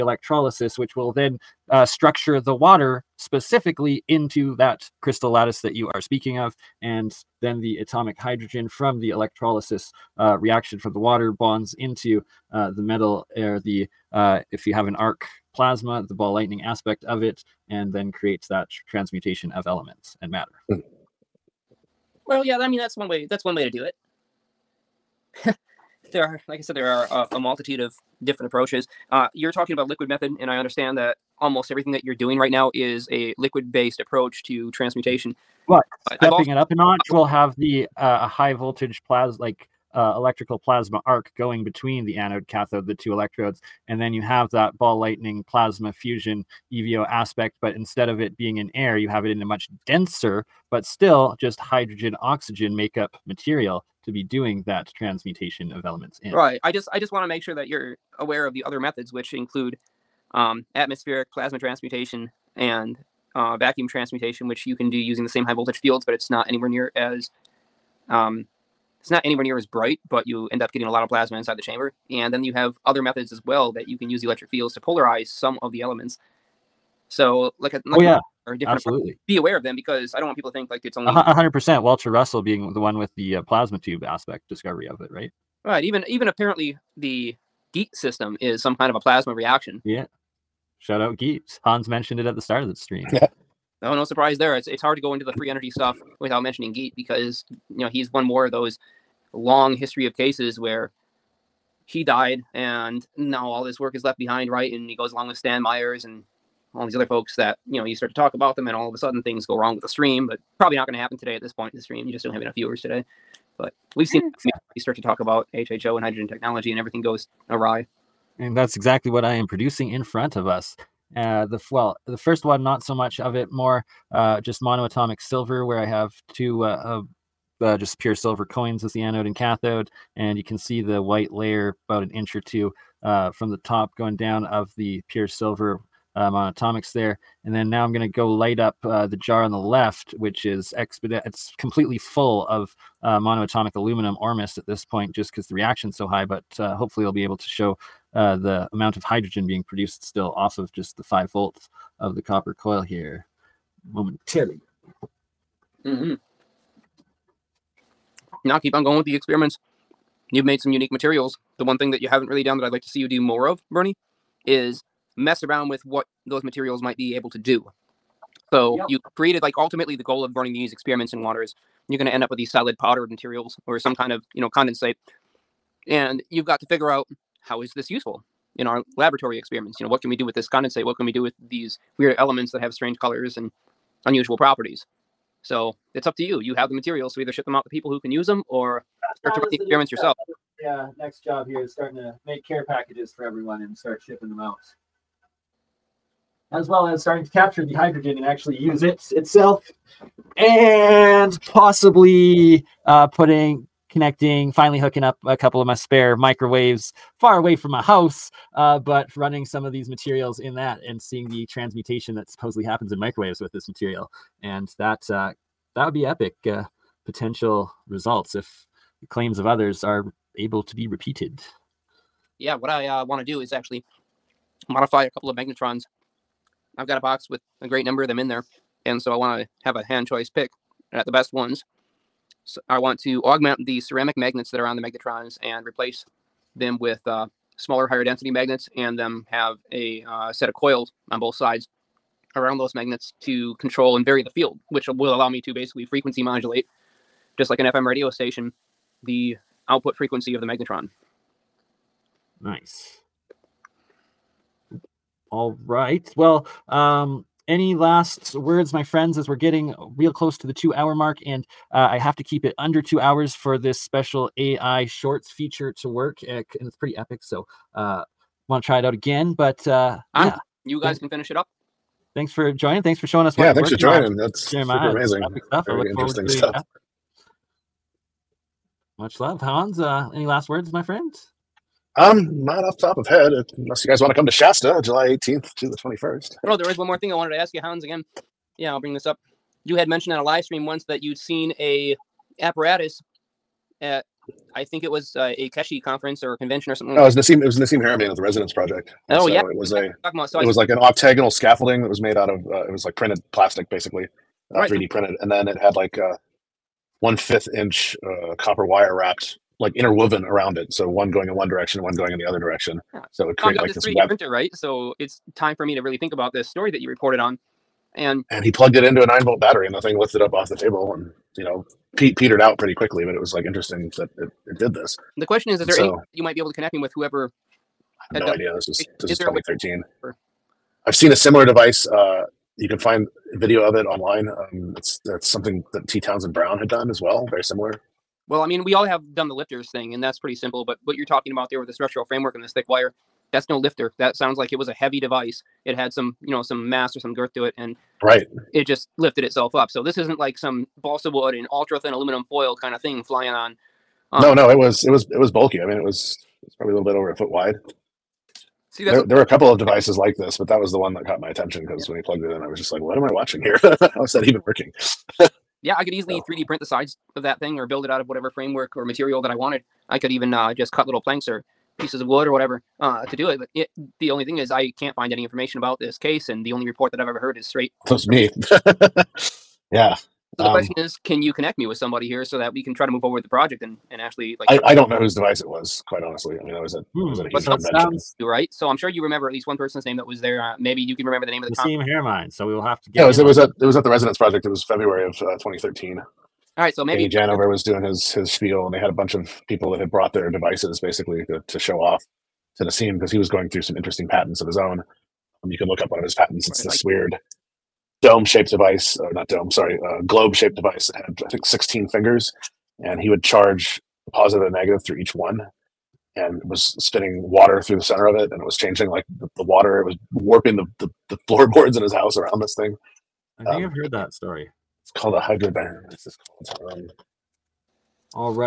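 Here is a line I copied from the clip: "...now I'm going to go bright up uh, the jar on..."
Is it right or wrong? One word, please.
wrong.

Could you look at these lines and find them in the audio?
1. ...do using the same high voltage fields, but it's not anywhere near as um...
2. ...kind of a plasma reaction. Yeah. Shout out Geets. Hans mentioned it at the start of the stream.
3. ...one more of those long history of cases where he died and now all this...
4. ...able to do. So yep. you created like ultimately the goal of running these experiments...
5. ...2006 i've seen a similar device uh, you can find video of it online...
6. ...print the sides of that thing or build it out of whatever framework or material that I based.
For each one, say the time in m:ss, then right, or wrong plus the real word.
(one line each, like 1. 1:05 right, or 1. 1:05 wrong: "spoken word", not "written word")
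1. 1:04 right
2. 1:28 right
3. 1:38 right
4. 2:47 right
5. 5:29 wrong: "2013", not "2006"
6. 6:06 wrong: "wanted", not "based".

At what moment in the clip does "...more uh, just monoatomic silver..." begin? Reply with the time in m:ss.
2:03.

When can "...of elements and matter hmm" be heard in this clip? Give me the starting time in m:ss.
0:19.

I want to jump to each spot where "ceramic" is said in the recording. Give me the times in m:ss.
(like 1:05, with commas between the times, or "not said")
3:53.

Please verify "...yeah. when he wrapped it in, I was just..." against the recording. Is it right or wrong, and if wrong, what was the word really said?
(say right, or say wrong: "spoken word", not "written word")
wrong: "plugged", not "wrapped".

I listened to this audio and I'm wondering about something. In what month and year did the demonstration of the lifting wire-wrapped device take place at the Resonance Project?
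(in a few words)
February 2013.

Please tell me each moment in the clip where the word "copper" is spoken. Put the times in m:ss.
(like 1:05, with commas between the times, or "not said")
2:32, 5:08.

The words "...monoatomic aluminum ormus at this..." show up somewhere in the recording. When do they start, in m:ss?
2:23.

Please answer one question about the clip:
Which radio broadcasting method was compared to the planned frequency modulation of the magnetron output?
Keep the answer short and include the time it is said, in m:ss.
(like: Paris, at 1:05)
FM radio, at 4:07.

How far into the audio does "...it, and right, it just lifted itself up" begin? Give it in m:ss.
5:47.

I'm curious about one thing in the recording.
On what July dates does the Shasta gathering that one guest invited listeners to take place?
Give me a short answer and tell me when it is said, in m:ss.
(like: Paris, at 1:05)
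July 18 to 21, at 4:44.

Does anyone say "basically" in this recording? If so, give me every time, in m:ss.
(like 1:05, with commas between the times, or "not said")
4:05, 5:03, 6:40.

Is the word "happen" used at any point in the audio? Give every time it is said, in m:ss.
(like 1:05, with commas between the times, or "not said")
1:50, 3:32.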